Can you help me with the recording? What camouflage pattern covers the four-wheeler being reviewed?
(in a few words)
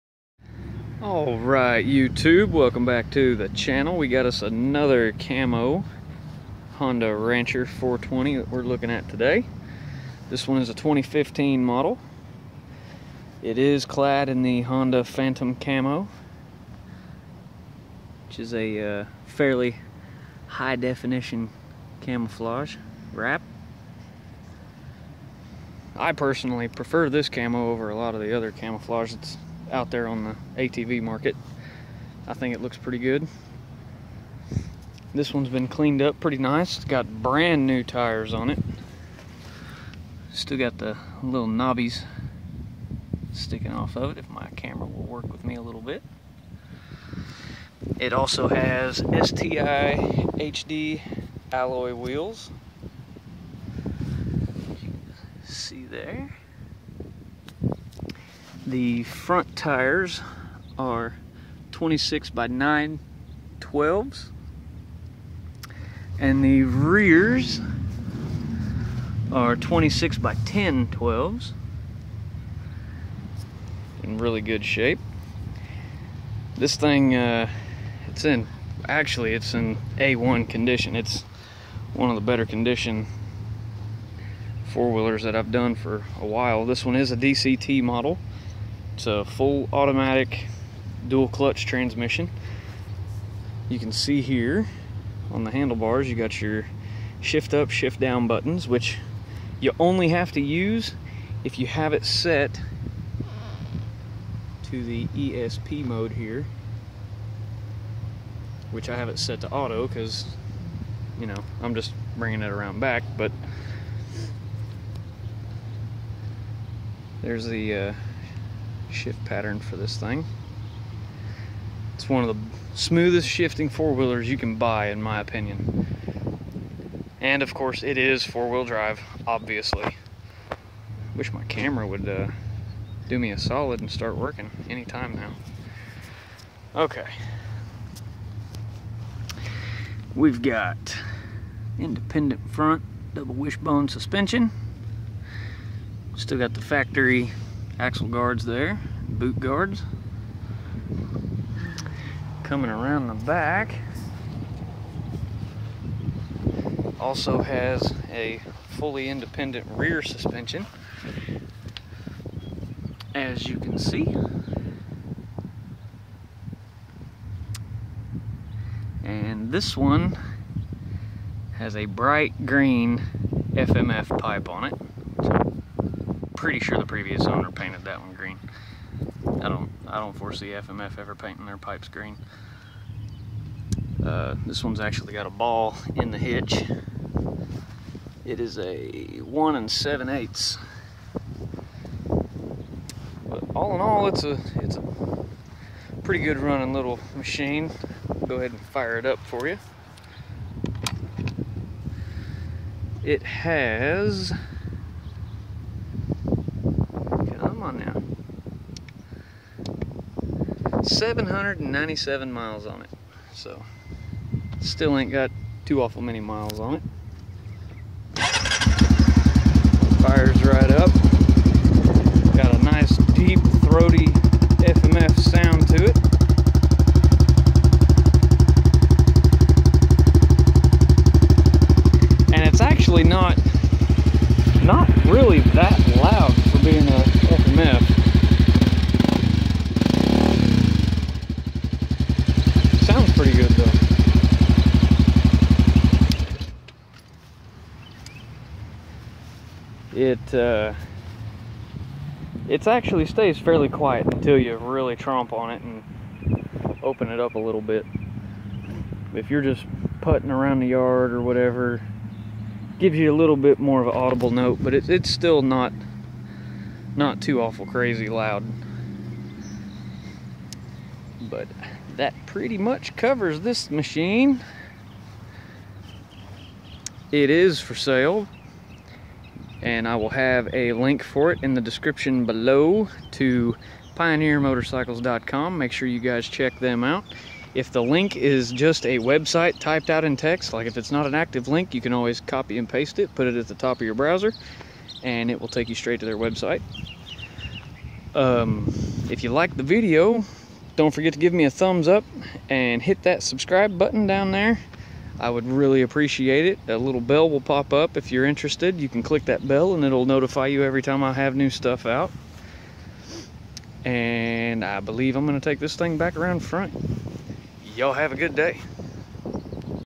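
Honda Phantom camo.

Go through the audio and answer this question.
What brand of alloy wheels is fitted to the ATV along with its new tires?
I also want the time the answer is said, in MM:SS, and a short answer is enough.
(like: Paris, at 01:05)
STI HD, at 00:48.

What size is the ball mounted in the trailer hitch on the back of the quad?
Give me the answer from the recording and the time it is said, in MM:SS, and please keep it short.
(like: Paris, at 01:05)
1 7/8, at 03:09.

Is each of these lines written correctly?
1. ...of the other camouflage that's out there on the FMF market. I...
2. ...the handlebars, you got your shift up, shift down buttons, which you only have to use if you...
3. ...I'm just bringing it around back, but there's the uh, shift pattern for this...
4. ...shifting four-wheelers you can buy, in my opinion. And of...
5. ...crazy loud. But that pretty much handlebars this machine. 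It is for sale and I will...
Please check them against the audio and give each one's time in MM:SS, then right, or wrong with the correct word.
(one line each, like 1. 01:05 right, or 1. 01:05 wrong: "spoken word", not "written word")
1. 00:28 wrong: "ATV", not "FMF"
2. 01:35 right
3. 01:51 right
4. 02:03 right
5. 04:27 wrong: "covers", not "handlebars".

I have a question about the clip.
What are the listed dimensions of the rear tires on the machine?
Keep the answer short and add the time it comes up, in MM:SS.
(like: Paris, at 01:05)
26 by 10 12, at 01:09.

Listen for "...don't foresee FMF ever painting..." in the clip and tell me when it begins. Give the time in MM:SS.
02:59.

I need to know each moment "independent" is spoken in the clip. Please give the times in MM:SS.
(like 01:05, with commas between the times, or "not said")
02:21, 02:39.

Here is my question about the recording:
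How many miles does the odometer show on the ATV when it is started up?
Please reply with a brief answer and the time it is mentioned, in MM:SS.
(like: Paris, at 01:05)
797, at 03:30.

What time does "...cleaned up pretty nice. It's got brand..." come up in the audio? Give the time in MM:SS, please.
00:35.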